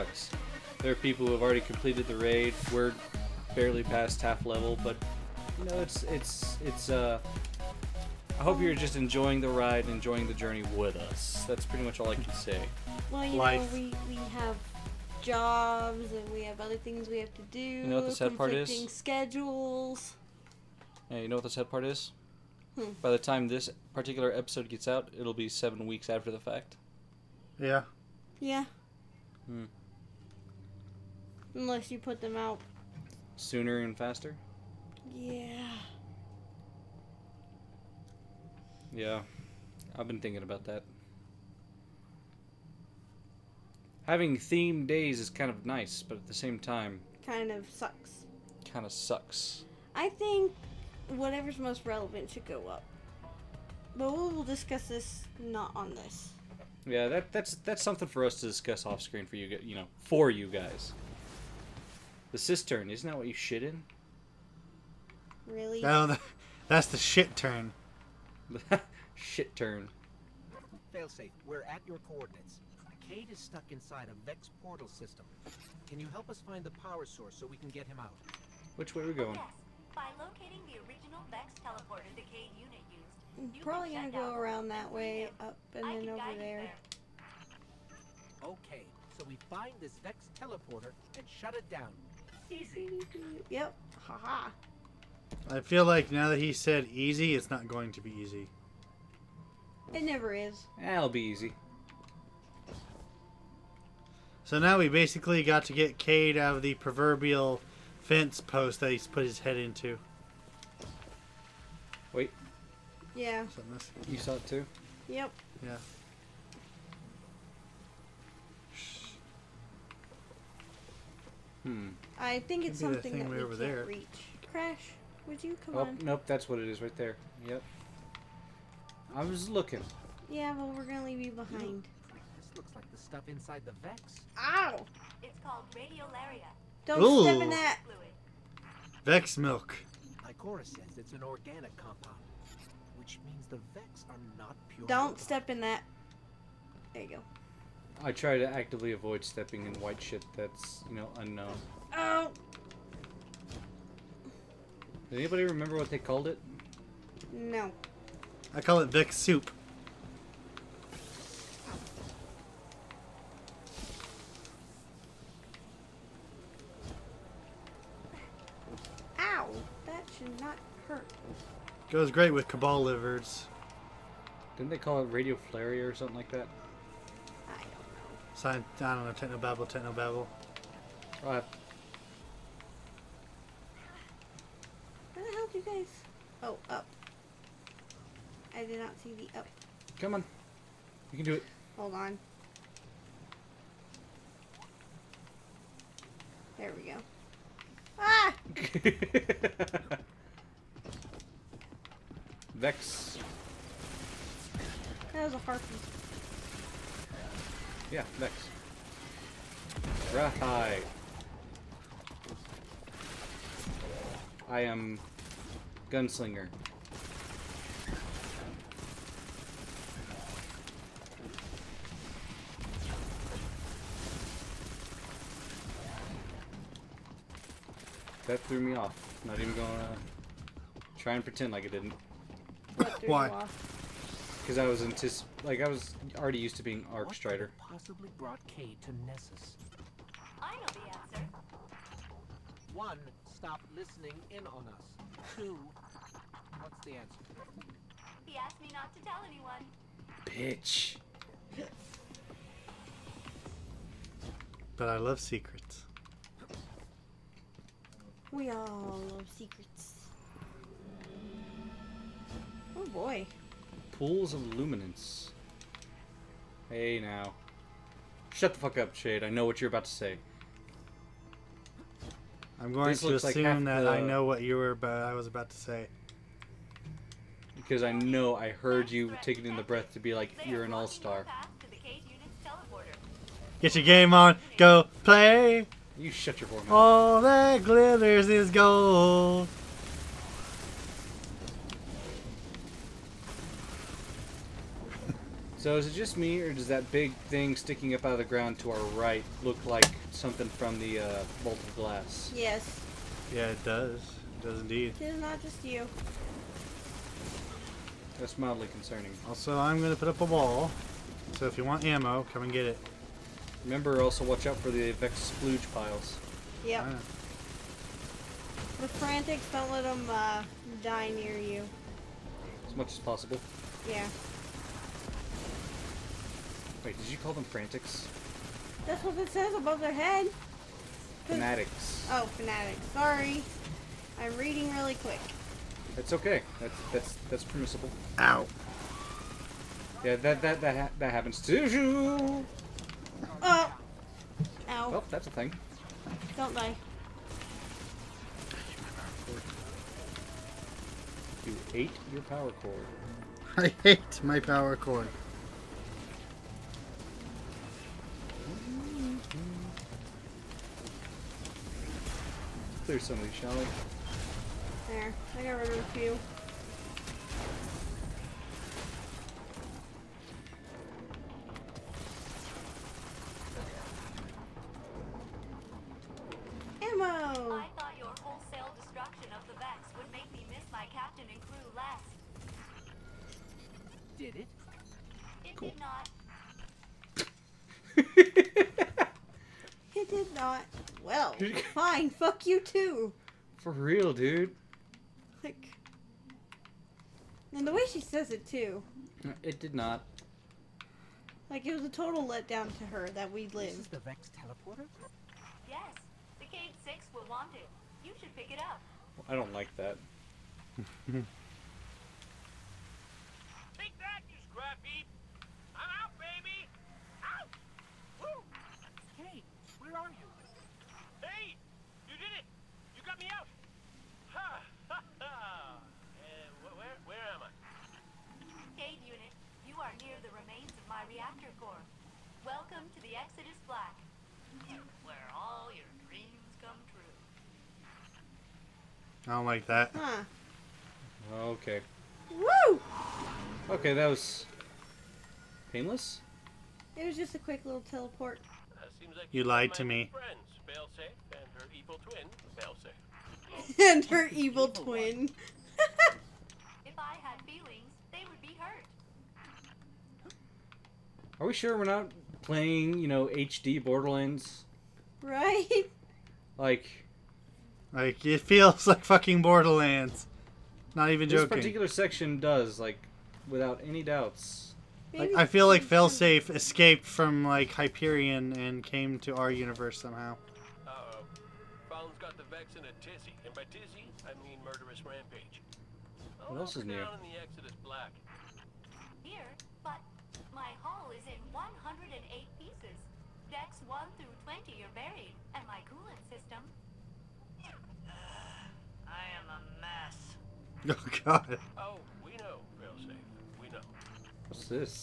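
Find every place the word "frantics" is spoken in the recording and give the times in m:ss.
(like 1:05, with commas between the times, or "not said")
5:18, 5:27.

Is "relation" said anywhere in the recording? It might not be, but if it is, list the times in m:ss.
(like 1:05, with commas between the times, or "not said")
not said.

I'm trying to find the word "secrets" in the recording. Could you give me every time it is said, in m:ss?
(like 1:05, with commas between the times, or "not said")
4:15, 4:19.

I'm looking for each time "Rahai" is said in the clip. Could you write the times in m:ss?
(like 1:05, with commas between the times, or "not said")
3:30.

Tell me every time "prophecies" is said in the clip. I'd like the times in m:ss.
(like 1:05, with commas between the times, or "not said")
not said.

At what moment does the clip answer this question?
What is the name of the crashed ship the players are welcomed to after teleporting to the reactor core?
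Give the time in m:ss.
7:13.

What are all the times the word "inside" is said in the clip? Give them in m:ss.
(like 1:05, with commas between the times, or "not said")
1:13, 2:13.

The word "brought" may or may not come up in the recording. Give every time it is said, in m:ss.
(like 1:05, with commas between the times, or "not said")
3:58.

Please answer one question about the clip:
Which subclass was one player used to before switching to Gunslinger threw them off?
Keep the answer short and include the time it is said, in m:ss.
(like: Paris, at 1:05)
Arc Strider, at 3:56.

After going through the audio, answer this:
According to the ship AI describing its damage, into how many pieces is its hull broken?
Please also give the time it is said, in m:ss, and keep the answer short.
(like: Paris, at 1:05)
108, at 8:11.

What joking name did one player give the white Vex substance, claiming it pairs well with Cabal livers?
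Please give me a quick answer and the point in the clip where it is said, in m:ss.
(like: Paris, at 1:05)
Vex soup, at 2:38.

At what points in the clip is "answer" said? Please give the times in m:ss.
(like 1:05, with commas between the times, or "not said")
4:01, 4:06.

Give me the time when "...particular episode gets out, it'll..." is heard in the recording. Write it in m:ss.
0:23.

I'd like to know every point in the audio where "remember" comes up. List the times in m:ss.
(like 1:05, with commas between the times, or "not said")
2:35, 5:13.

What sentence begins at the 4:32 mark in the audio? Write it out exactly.
I'm going this to assume like that the...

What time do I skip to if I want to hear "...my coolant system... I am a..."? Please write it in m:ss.
8:15.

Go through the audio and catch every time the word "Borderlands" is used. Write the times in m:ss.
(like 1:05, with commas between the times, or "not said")
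7:43, 7:49.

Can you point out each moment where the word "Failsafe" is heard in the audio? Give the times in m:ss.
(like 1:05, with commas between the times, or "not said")
1:10, 7:55.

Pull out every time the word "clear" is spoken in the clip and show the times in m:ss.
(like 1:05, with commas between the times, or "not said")
6:02.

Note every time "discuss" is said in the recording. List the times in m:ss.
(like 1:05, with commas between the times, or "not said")
0:54, 0:58.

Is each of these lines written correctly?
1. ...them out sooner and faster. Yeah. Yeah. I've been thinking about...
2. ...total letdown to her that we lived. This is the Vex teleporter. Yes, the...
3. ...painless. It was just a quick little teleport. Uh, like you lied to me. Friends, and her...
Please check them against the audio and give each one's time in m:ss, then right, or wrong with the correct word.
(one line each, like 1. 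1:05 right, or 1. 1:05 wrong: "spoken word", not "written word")
1. 0:32 right
2. 6:41 right
3. 7:25 right.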